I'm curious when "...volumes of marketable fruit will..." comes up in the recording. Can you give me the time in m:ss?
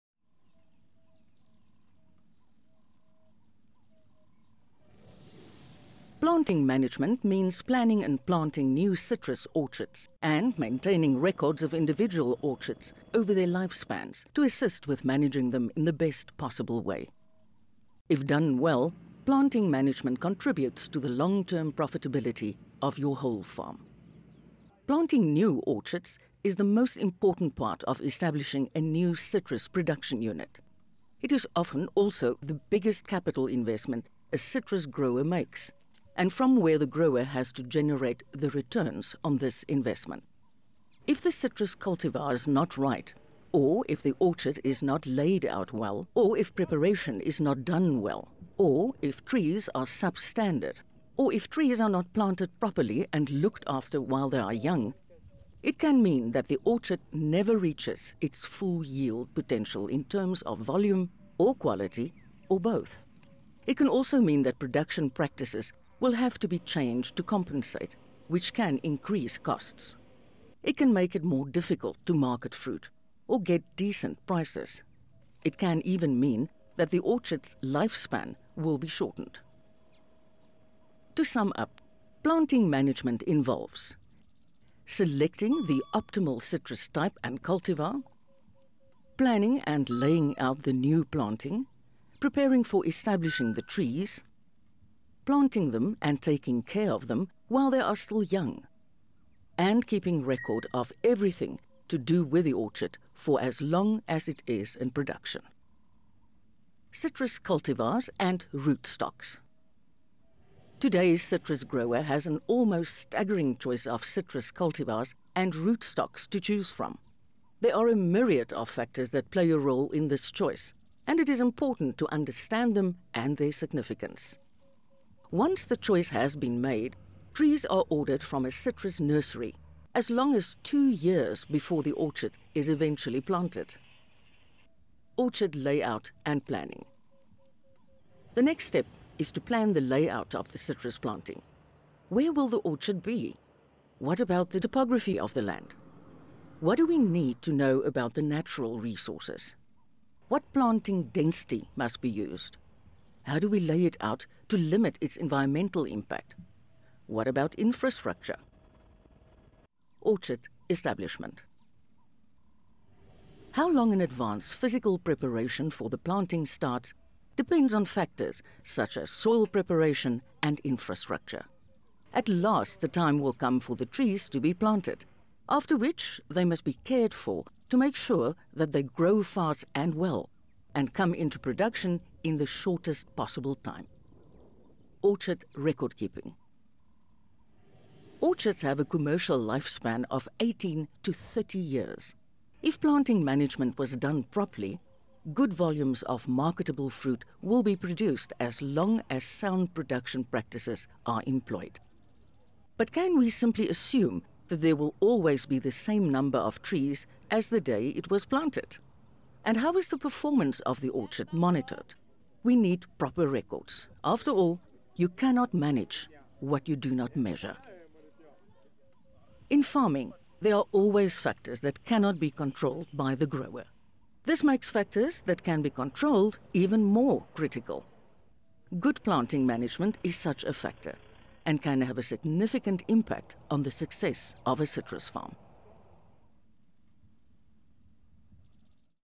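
3:15.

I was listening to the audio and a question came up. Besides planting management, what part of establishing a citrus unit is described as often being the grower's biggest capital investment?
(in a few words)
Planting new orchards.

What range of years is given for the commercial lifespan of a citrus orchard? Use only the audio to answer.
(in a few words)
18 to 30 years.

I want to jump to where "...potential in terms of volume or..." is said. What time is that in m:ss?
0:59.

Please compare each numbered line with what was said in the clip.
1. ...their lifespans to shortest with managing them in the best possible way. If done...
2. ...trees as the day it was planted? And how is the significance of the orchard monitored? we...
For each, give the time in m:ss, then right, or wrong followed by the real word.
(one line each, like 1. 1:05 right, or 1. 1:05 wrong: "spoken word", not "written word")
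1. 0:13 wrong: "assist", not "shortest"
2. 3:26 wrong: "performance", not "significance".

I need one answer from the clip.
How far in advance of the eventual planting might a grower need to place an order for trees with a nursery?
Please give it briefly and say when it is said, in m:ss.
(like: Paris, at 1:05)
2 years, at 2:10.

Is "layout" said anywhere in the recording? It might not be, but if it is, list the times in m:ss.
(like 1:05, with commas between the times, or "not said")
2:15, 2:19.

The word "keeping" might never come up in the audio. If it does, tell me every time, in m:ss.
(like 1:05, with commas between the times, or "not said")
1:39, 3:05.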